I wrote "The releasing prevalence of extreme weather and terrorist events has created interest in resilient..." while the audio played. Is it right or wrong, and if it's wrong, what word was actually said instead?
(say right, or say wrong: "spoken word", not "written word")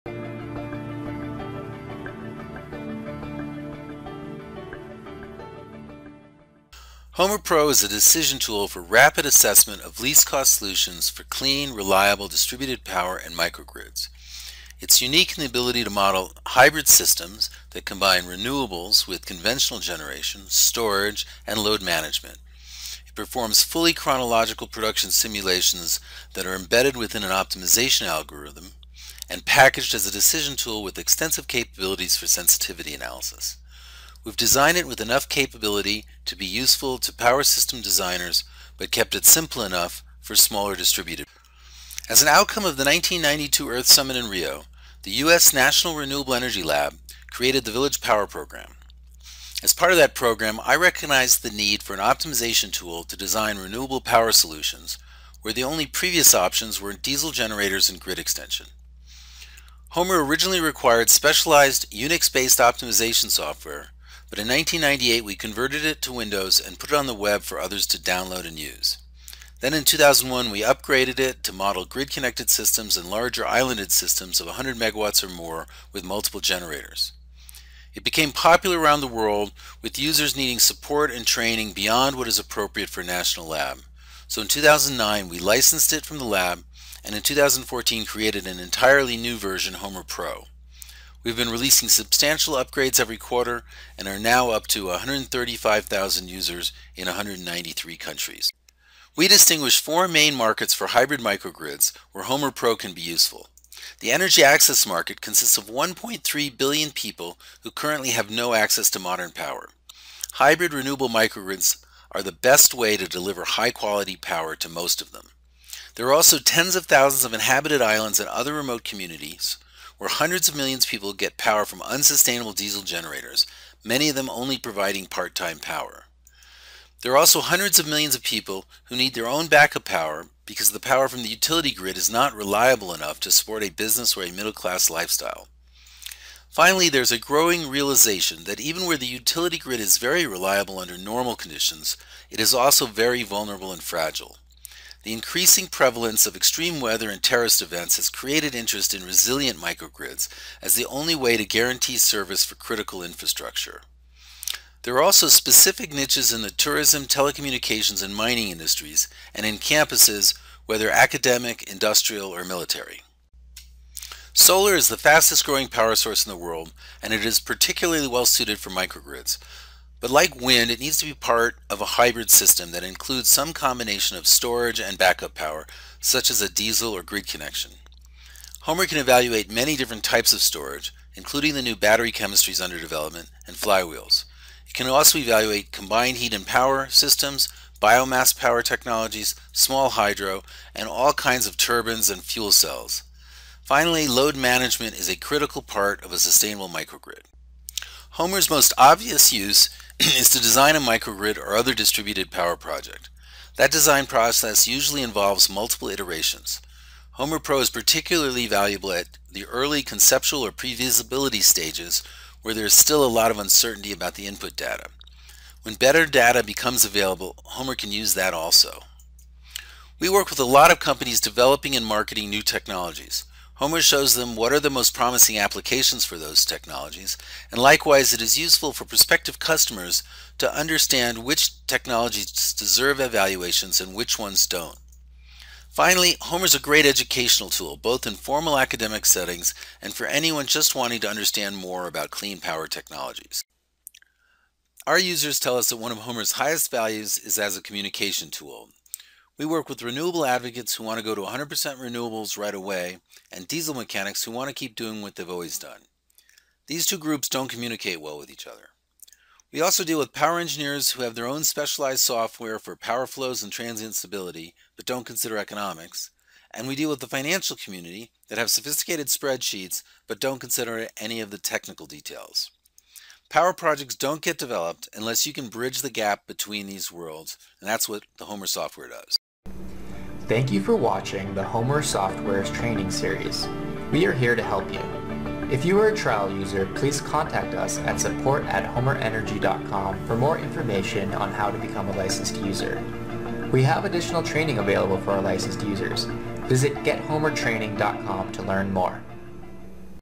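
wrong: "increasing", not "releasing".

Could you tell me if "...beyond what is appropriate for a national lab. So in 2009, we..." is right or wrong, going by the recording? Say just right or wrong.
right.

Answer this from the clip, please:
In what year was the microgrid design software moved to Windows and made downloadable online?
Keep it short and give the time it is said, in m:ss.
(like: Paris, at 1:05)
1998, at 1:04.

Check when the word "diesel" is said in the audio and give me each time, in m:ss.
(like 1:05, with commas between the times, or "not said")
0:56, 2:02, 2:56, 4:13.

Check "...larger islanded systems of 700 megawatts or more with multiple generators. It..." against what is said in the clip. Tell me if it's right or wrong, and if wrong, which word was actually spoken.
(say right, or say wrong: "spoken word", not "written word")
wrong: "100", not "700".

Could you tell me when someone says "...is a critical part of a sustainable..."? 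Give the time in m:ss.
3:14.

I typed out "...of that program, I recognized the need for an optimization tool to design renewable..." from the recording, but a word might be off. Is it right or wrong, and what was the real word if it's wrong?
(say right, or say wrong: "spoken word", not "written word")
right.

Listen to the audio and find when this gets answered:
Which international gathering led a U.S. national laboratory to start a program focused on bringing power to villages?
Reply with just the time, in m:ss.
0:42.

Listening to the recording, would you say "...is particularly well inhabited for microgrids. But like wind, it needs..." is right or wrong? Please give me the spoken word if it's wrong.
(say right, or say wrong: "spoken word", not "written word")
wrong: "suited", not "inhabited".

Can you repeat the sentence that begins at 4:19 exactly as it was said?
We also deal with power engineers who have their own specialized software for power flows and transient stability, but don't consider economics.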